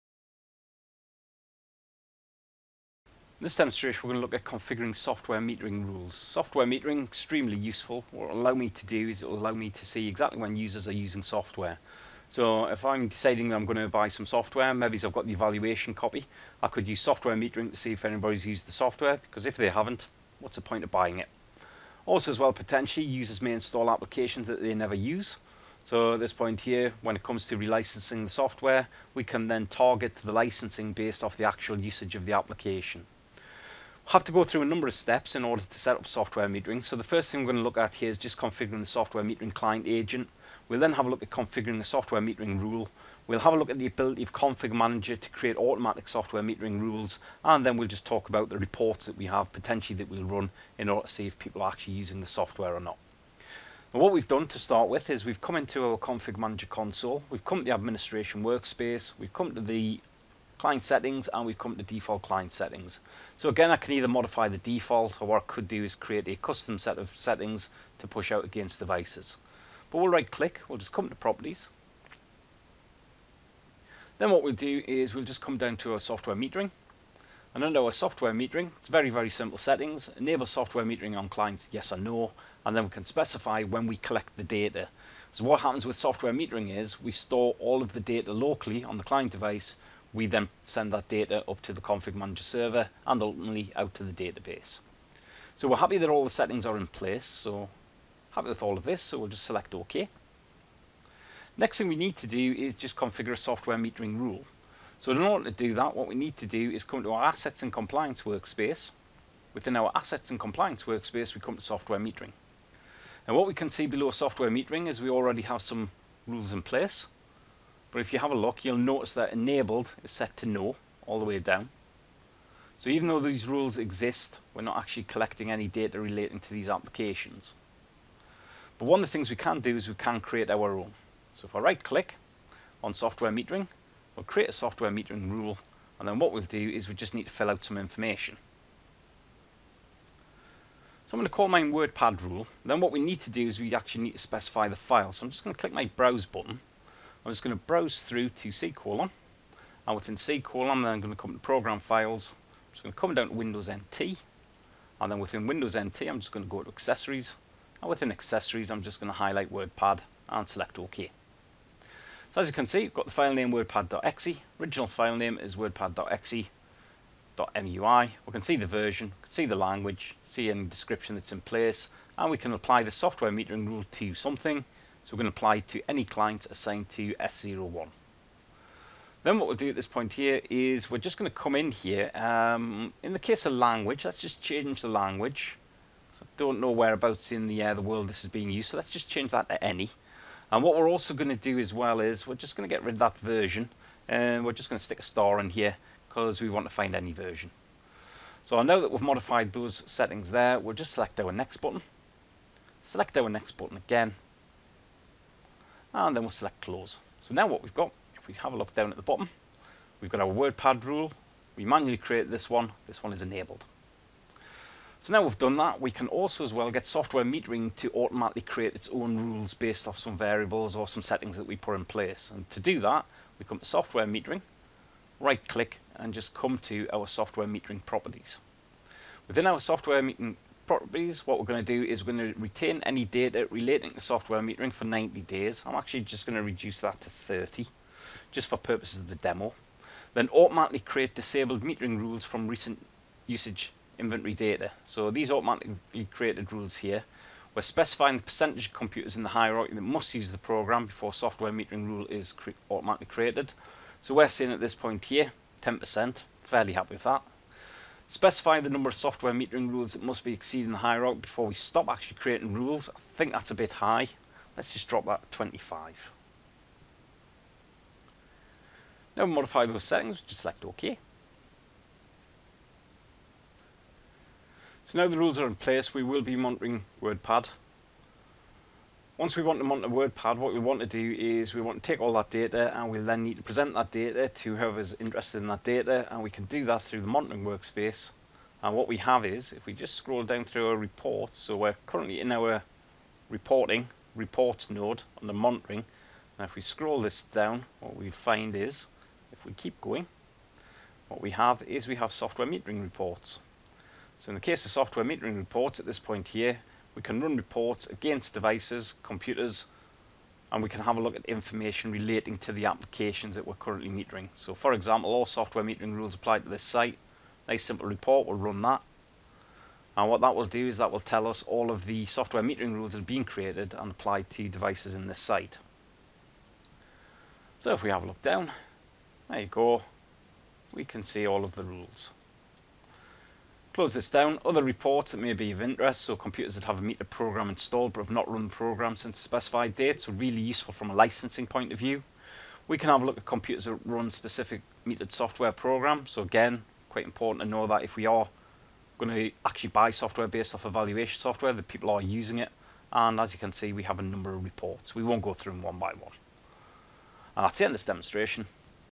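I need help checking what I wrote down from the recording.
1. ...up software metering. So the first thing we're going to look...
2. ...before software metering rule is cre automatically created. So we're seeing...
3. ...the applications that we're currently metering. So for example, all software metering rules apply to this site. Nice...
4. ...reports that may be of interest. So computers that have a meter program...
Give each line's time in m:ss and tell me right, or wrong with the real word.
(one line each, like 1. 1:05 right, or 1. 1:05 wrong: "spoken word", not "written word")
1. 0:35 right
2. 4:10 right
3. 5:12 right
4. 5:34 right.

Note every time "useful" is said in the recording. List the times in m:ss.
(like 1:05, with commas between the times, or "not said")
0:07, 5:40.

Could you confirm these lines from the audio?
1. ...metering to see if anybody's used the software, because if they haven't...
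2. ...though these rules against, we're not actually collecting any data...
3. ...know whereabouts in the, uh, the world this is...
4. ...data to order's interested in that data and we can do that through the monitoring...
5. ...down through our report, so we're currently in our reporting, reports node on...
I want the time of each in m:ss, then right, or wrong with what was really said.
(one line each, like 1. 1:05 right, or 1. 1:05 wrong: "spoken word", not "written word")
1. 0:17 right
2. 2:03 wrong: "exist", not "against"
3. 3:06 right
4. 4:43 wrong: "whoever", not "order"
5. 4:50 right.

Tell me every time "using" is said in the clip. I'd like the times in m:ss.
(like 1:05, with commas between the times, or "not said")
0:10, 0:51, 5:52.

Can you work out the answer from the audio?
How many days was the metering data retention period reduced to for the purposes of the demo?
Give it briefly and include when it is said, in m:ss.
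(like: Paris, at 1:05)
30, at 3:57.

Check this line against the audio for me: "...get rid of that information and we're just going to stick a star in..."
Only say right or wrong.
wrong.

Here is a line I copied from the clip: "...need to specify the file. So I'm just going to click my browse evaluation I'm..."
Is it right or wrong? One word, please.
wrong.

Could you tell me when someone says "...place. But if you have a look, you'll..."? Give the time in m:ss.
1:56.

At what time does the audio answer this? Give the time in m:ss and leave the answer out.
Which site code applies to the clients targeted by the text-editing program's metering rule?
2:57.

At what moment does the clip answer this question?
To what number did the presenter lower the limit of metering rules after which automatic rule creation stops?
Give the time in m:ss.
4:25.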